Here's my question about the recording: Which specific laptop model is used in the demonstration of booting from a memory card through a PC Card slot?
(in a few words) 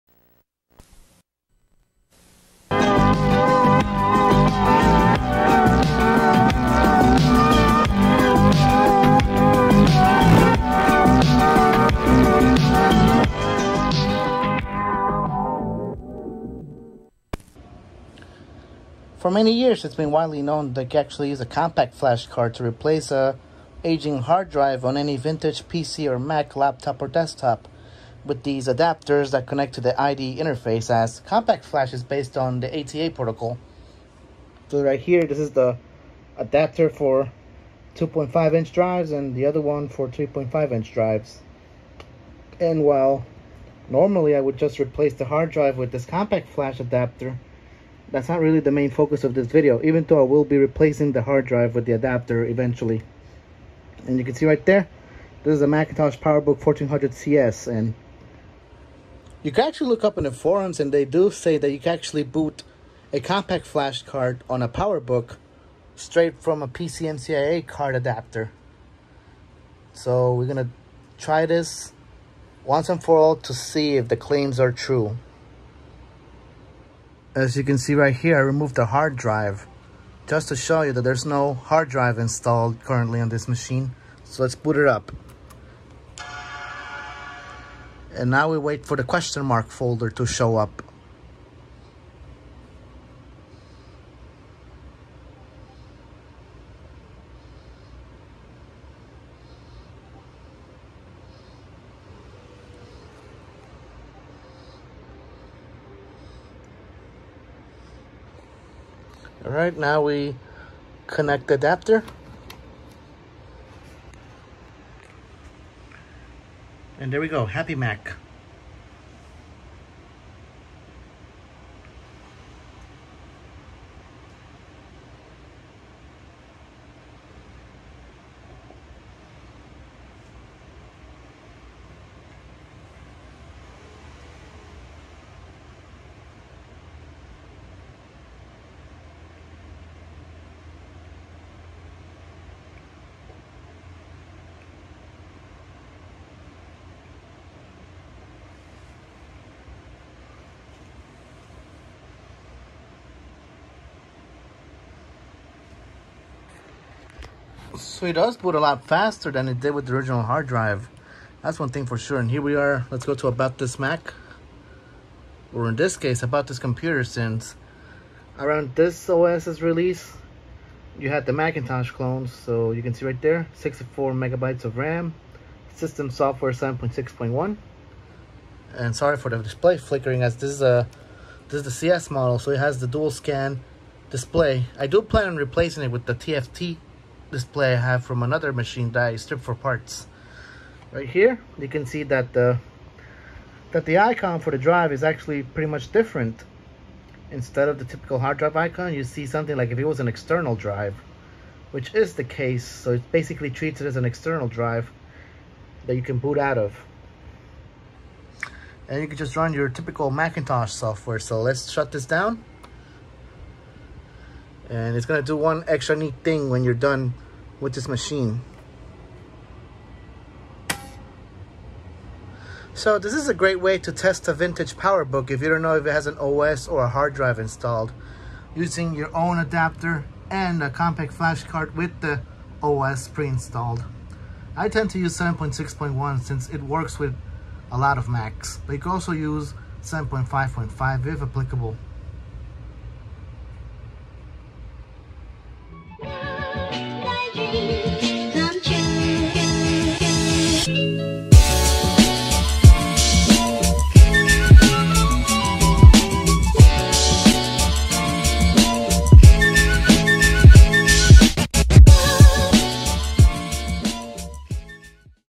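PowerBook 1400 CS.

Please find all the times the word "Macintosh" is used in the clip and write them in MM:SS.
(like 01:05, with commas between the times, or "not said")
00:55, 02:51, 03:30.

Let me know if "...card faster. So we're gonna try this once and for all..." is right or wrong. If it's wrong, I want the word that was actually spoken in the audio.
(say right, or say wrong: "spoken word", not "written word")
wrong: "adapter", not "faster".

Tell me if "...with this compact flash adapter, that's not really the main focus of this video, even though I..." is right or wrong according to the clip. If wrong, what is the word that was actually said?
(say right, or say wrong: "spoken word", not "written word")
right.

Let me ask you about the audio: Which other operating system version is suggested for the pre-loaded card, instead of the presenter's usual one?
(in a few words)
7.5.5.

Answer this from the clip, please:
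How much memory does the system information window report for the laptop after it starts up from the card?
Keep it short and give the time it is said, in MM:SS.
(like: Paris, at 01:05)
64 megabytes, at 02:53.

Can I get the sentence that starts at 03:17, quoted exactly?
Instead of the typical hard drive icon, you see something like if it was an external drive, which is the case.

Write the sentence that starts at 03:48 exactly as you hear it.
Using your own adapter and a compact flash card with the OS pre-installed.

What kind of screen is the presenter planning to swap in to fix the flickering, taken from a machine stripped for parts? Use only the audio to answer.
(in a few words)
TFT display.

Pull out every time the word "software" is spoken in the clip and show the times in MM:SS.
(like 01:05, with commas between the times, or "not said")
02:56, 03:30.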